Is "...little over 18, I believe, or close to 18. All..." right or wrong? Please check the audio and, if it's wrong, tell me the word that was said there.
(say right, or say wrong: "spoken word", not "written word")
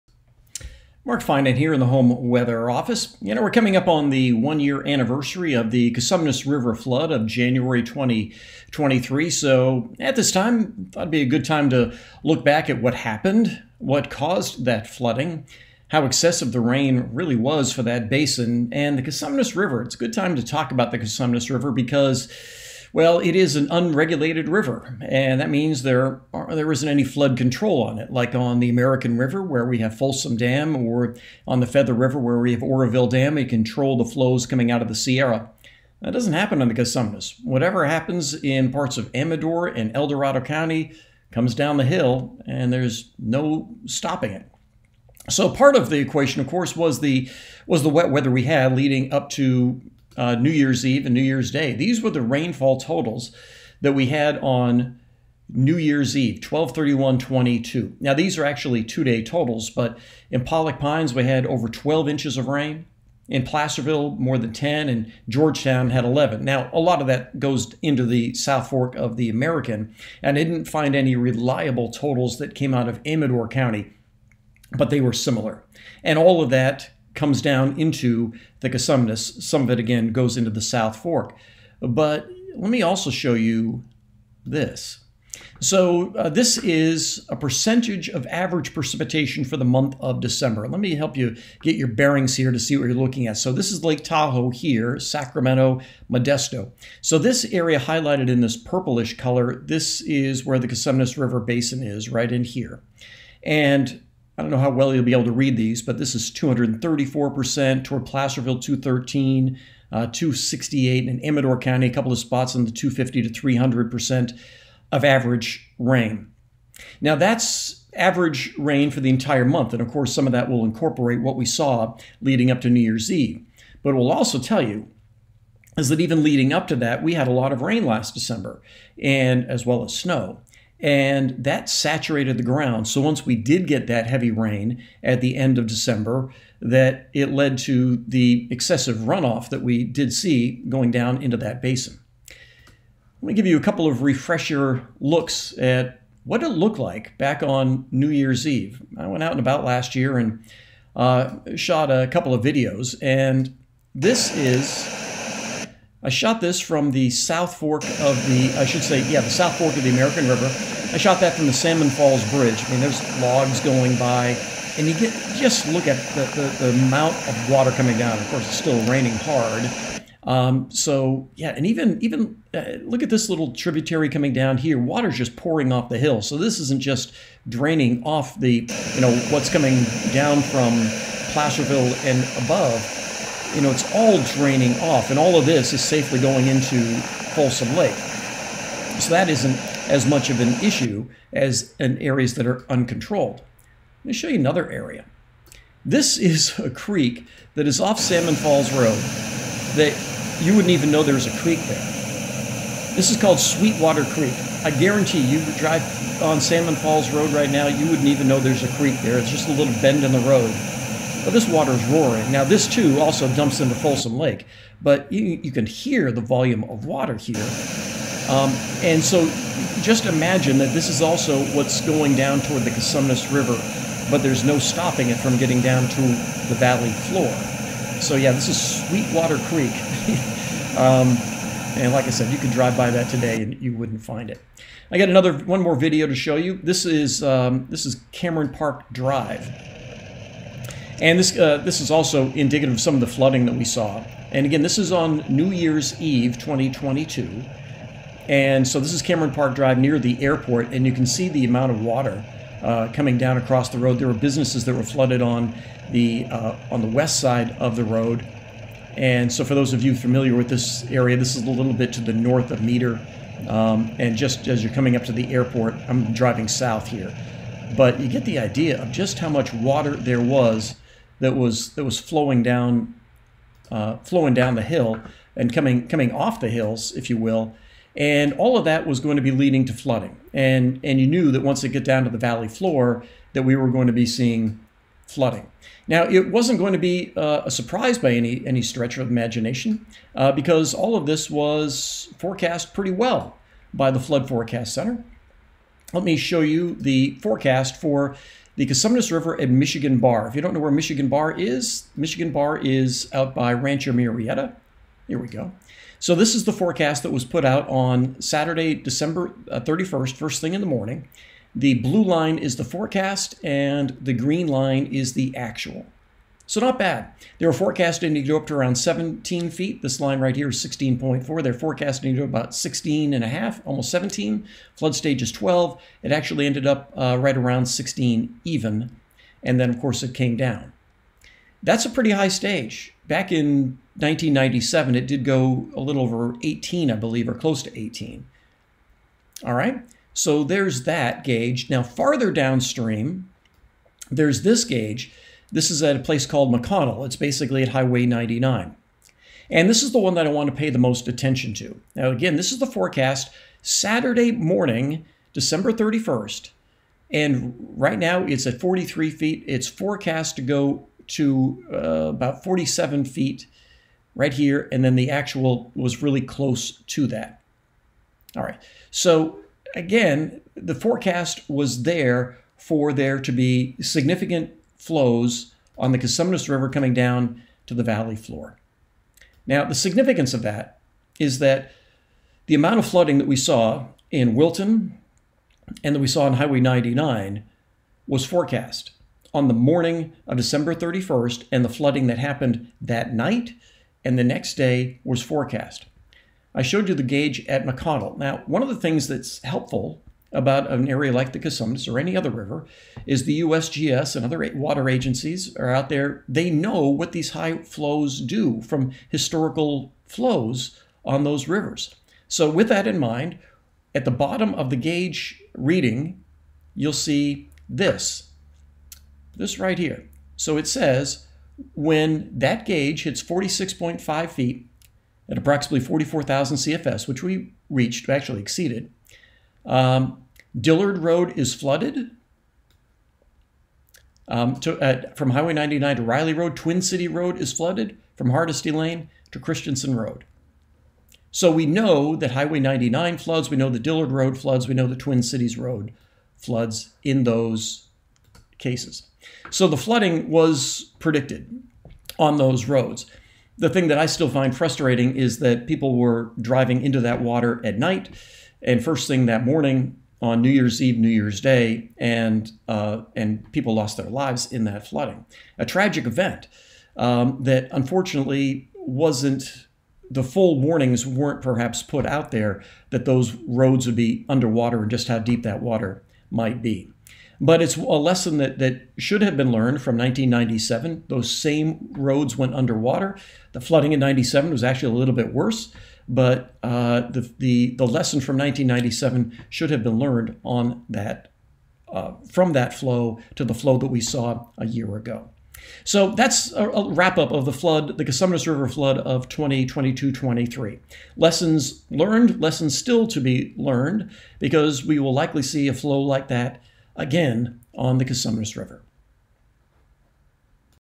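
right.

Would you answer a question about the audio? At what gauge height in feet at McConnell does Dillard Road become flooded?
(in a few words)
46.5 feet.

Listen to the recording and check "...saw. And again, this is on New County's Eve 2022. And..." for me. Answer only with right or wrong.
wrong.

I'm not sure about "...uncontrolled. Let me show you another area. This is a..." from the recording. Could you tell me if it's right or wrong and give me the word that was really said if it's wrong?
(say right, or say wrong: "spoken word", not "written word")
right.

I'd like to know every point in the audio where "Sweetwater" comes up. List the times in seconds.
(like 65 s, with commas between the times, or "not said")
203 s, 228 s.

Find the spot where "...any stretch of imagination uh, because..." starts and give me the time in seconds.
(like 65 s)
288 s.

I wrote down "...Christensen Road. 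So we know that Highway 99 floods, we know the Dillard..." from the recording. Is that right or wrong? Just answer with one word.
right.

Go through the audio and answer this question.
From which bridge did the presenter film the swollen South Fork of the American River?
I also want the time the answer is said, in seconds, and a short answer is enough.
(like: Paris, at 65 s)
Salmon Falls Bridge, at 161 s.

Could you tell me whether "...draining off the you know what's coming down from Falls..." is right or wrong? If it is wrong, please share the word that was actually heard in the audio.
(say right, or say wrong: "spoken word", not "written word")
wrong: "Placerville", not "Falls".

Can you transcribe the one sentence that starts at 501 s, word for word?
Lessons learned, lessons still to be learned, because we will likely see a flow like that again on the Cosumnes River.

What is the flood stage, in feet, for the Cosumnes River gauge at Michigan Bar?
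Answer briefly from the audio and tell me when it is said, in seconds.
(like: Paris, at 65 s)
12, at 324 s.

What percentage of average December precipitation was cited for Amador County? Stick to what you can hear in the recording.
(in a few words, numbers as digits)
268%.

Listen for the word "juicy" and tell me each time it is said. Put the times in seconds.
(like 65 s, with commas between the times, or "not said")
not said.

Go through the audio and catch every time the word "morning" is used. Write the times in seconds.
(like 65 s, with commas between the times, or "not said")
310 s, 354 s, 389 s, 459 s.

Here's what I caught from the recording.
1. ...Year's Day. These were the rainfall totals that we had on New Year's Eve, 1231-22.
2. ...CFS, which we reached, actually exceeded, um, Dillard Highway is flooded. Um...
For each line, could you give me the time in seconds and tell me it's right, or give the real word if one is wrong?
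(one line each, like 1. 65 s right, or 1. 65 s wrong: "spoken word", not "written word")
1. 51 s right
2. 426 s wrong: "Road", not "Highway".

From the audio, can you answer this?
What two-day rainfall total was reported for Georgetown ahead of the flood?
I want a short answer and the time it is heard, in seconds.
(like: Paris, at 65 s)
11 inches, at 65 s.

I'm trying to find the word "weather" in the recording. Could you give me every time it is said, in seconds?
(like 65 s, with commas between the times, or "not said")
2 s, 48 s.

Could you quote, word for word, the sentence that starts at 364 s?
And then the actual was really close to that.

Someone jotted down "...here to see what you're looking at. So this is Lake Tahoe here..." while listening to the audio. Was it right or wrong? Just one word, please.
right.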